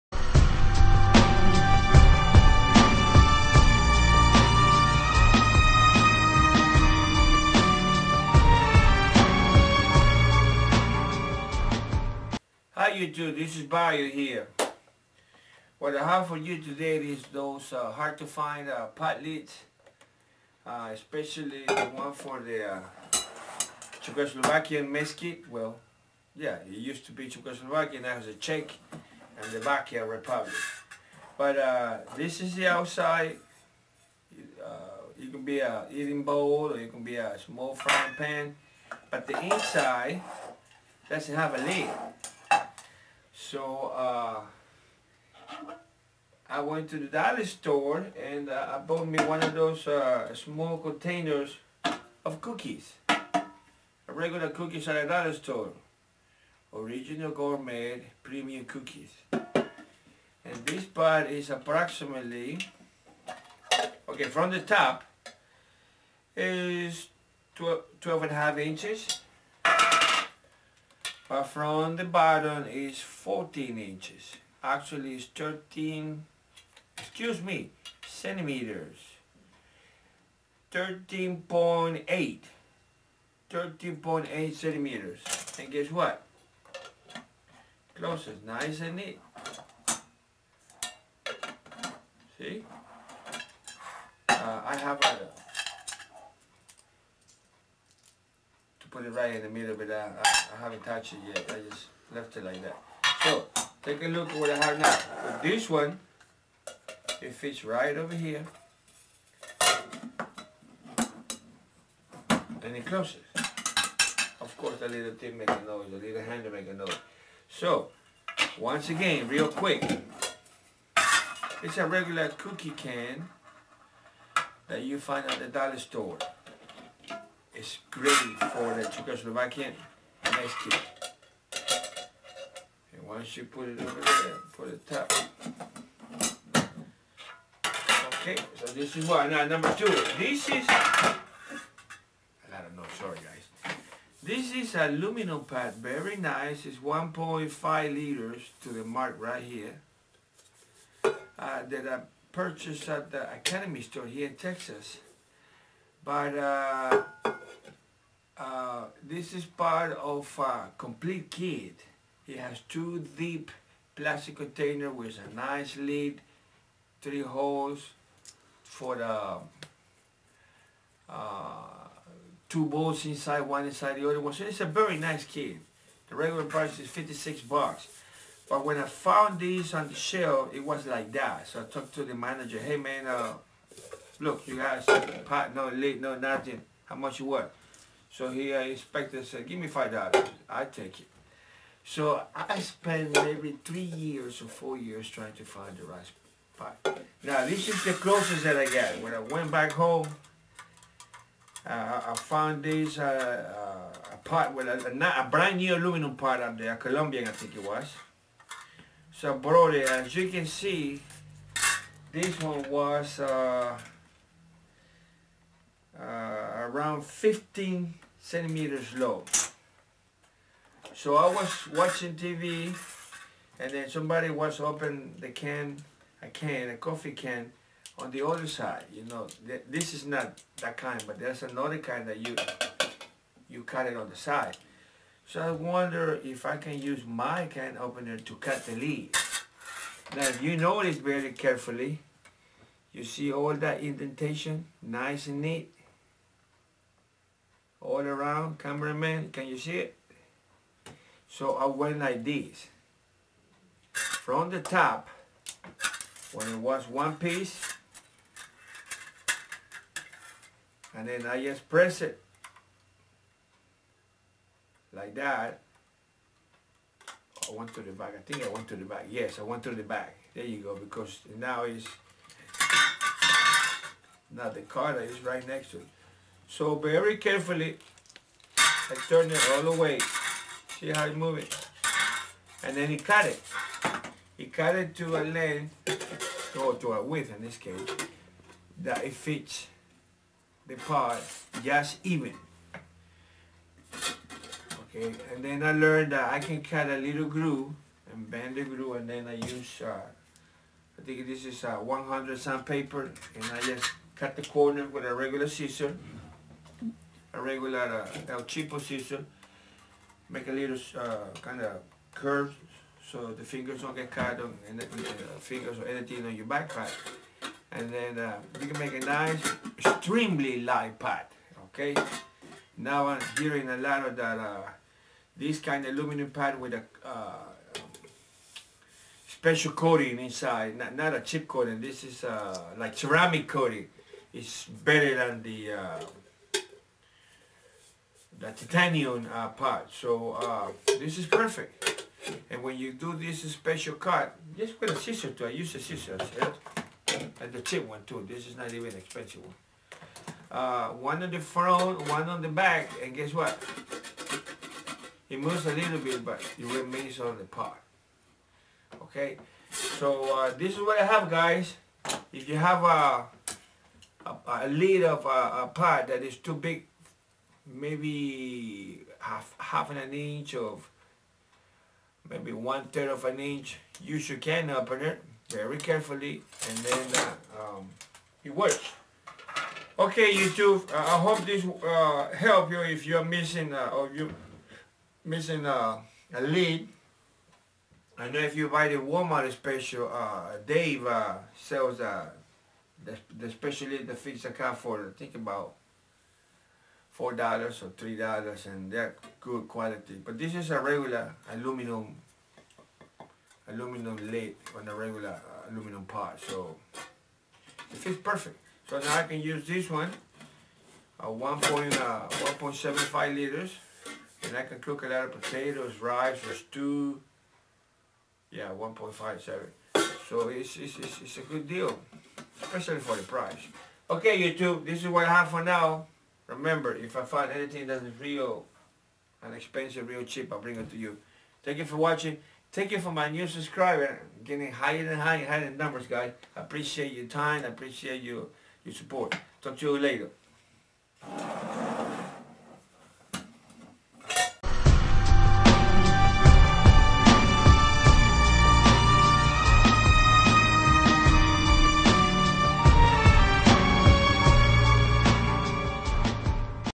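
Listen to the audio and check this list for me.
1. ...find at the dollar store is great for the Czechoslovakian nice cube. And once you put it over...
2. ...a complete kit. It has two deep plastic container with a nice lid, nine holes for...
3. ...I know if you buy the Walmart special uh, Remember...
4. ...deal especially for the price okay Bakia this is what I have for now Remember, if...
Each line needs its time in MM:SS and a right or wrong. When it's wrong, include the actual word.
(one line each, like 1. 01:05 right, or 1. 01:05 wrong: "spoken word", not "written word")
1. 02:04 right
2. 02:40 wrong: "three", not "nine"
3. 06:28 wrong: "Dave", not "Remember"
4. 07:01 wrong: "YouTube", not "Bakia".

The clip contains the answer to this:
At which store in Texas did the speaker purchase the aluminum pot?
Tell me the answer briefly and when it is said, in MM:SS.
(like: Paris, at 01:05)
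Academy, at 02:33.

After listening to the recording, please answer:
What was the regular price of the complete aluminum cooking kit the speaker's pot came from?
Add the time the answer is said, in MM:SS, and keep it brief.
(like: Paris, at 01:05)
56 dollars, at 02:56.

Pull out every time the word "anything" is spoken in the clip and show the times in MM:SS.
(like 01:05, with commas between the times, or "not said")
05:15, 07:07.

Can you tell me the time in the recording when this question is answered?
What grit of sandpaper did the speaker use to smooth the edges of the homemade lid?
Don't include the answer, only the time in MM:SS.
05:01.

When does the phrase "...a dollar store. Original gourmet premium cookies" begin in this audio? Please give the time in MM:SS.
00:55.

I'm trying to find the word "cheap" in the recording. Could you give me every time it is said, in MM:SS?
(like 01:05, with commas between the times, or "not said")
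05:47, 07:10.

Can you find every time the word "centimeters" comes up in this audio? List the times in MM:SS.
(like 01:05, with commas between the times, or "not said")
01:18, 01:24, 03:38.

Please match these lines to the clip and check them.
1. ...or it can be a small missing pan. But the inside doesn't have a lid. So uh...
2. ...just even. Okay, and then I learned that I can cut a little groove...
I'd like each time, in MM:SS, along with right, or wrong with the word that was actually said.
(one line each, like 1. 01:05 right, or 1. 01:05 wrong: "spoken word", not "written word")
1. 00:36 wrong: "frying", not "missing"
2. 04:51 right.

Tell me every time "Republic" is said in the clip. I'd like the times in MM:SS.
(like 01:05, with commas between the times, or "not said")
00:30.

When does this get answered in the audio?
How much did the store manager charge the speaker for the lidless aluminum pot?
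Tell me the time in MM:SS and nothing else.
03:09.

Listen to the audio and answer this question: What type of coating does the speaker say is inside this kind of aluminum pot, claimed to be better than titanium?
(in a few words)
ceramic coating.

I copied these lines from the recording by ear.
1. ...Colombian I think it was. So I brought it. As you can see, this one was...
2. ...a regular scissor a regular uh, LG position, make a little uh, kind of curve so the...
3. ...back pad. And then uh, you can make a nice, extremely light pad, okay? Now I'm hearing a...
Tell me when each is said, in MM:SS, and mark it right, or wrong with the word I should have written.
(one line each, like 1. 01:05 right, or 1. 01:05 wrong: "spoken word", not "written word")
1. 03:26 right
2. 05:05 right
3. 05:16 right.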